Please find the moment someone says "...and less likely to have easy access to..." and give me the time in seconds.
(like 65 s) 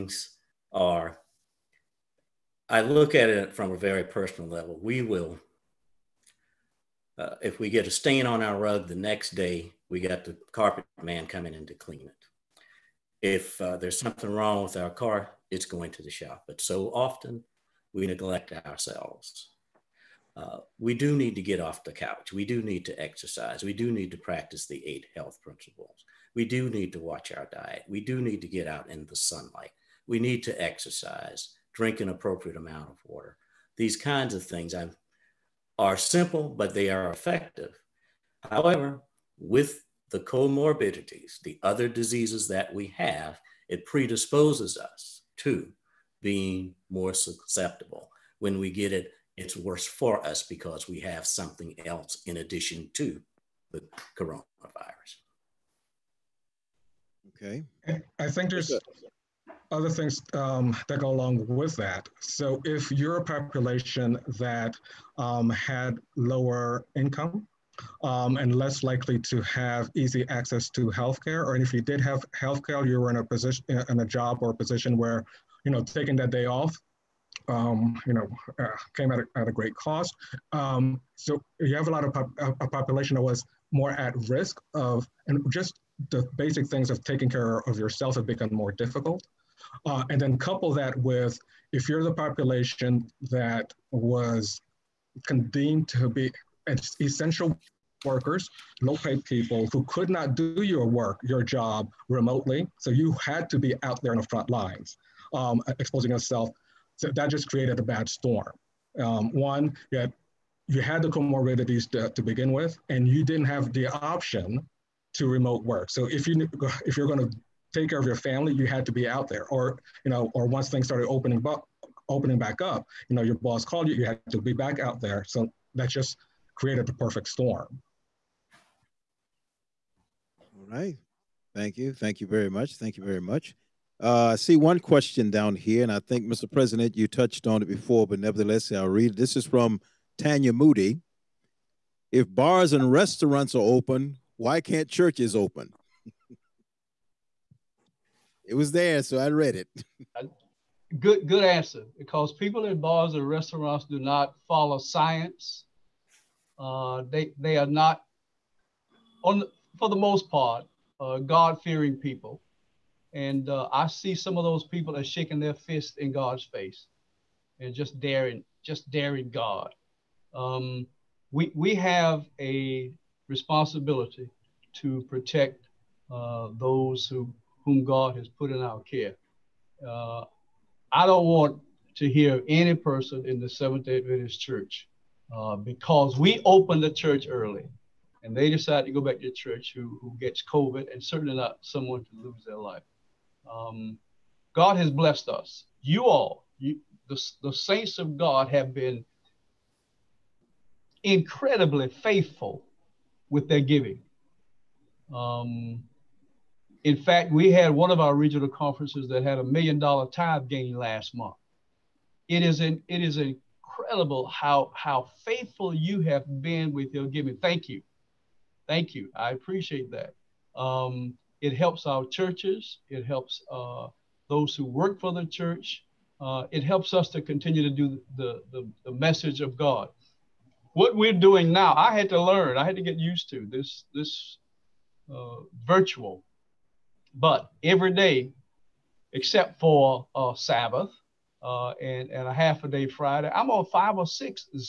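68 s.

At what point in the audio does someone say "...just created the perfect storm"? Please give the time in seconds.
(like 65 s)
125 s.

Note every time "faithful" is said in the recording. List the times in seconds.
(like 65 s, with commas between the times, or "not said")
201 s, 215 s.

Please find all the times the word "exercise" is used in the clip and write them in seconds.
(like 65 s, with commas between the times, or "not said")
22 s, 30 s.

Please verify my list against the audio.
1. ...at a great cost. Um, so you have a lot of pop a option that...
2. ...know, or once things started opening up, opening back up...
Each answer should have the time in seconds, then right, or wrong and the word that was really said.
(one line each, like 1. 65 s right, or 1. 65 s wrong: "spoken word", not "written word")
1. 79 s wrong: "population", not "option"
2. 120 s right.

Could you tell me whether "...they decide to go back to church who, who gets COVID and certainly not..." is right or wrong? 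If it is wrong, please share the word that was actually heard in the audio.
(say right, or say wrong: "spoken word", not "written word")
right.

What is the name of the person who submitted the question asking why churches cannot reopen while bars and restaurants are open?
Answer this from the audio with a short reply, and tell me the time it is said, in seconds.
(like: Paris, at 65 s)
Tanya Moody, at 140 s.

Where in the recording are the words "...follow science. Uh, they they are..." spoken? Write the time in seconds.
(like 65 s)
154 s.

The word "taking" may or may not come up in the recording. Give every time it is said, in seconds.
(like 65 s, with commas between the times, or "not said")
75 s, 87 s.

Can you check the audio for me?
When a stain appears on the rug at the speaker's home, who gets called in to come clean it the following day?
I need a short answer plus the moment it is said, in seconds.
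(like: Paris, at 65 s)
the carpet man, at 10 s.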